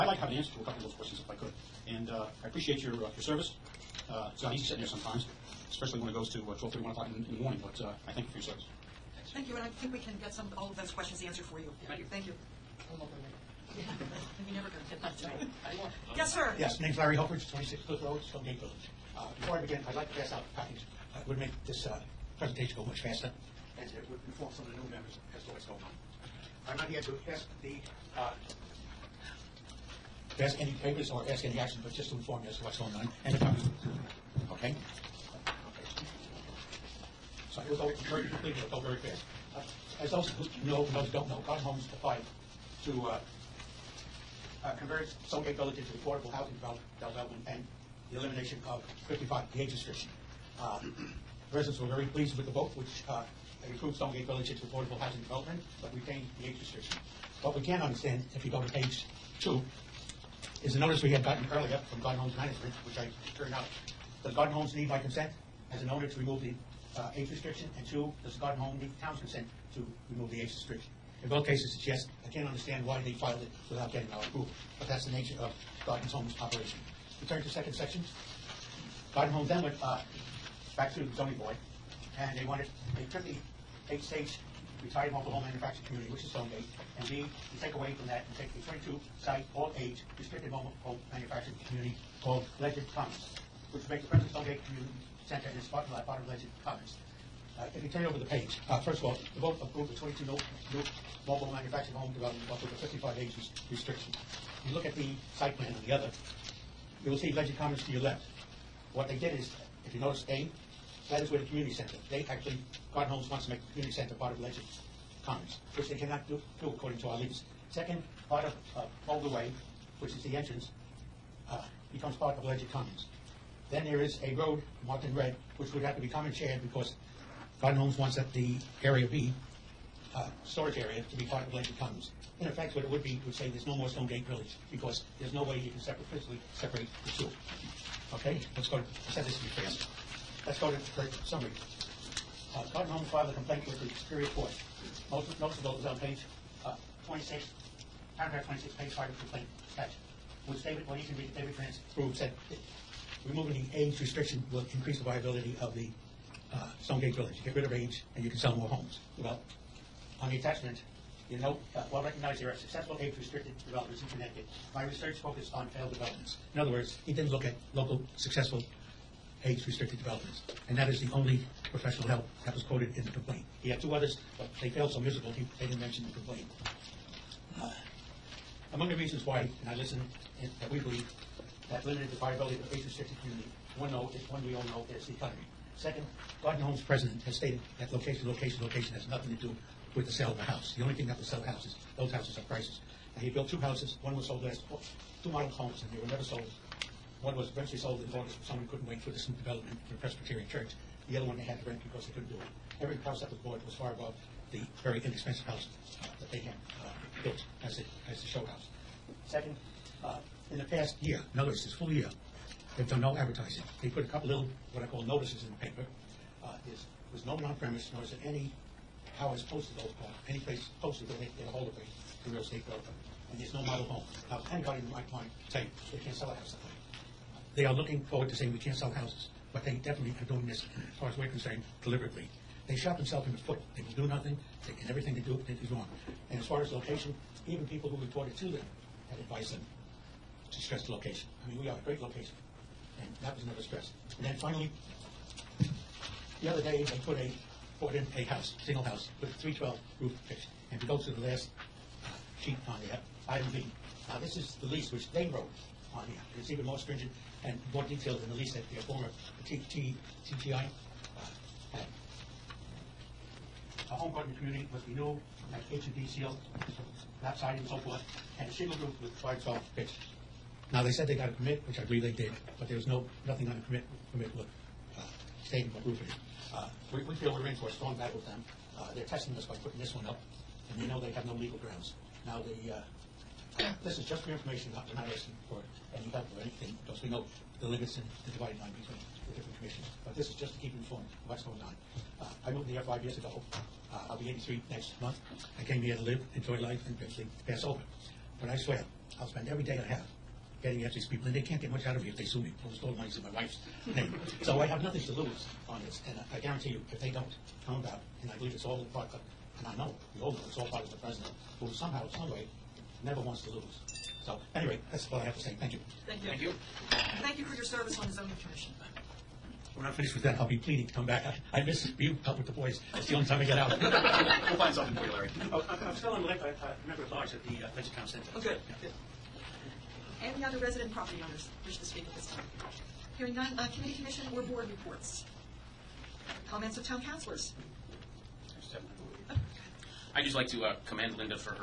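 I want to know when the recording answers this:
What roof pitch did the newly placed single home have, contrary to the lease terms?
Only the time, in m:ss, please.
4:09.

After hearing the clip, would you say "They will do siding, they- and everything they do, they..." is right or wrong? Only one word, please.
wrong.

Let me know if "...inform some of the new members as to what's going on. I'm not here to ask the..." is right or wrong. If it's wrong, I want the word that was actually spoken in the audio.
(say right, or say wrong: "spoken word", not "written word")
right.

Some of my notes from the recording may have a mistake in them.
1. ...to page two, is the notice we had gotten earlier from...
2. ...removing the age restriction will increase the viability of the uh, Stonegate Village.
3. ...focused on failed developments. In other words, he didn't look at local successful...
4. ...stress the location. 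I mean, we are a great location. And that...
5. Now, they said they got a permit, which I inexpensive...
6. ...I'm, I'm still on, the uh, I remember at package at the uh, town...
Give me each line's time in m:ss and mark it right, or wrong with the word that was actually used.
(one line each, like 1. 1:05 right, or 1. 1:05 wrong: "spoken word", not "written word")
1. 0:58 right
2. 2:33 right
3. 2:45 right
4. 4:00 right
5. 4:30 wrong: "believe", not "inexpensive"
6. 5:25 wrong: "large", not "package".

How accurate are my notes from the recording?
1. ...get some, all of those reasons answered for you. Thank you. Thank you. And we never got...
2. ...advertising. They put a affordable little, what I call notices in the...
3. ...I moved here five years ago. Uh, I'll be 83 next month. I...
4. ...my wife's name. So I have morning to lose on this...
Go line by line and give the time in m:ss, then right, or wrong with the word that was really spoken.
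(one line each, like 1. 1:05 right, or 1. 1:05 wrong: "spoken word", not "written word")
1. 0:10 wrong: "questions", not "reasons"
2. 3:33 wrong: "couple", not "affordable"
3. 4:52 right
4. 5:03 wrong: "nothing", not "morning".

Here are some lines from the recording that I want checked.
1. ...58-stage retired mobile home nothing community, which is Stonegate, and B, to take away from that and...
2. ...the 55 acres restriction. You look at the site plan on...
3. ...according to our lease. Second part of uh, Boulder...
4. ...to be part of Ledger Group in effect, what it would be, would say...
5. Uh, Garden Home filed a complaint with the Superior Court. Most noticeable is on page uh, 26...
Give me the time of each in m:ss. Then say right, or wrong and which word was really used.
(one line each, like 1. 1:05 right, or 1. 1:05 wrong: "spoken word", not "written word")
1. 1:23 wrong: "manufacturing", not "nothing"
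2. 1:42 right
3. 1:56 right
4. 2:11 wrong: "Commons", not "Group"
5. 2:22 right.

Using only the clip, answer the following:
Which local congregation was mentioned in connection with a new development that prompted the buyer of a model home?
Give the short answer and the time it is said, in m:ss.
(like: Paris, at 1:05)
Presbyterian Church, at 3:20.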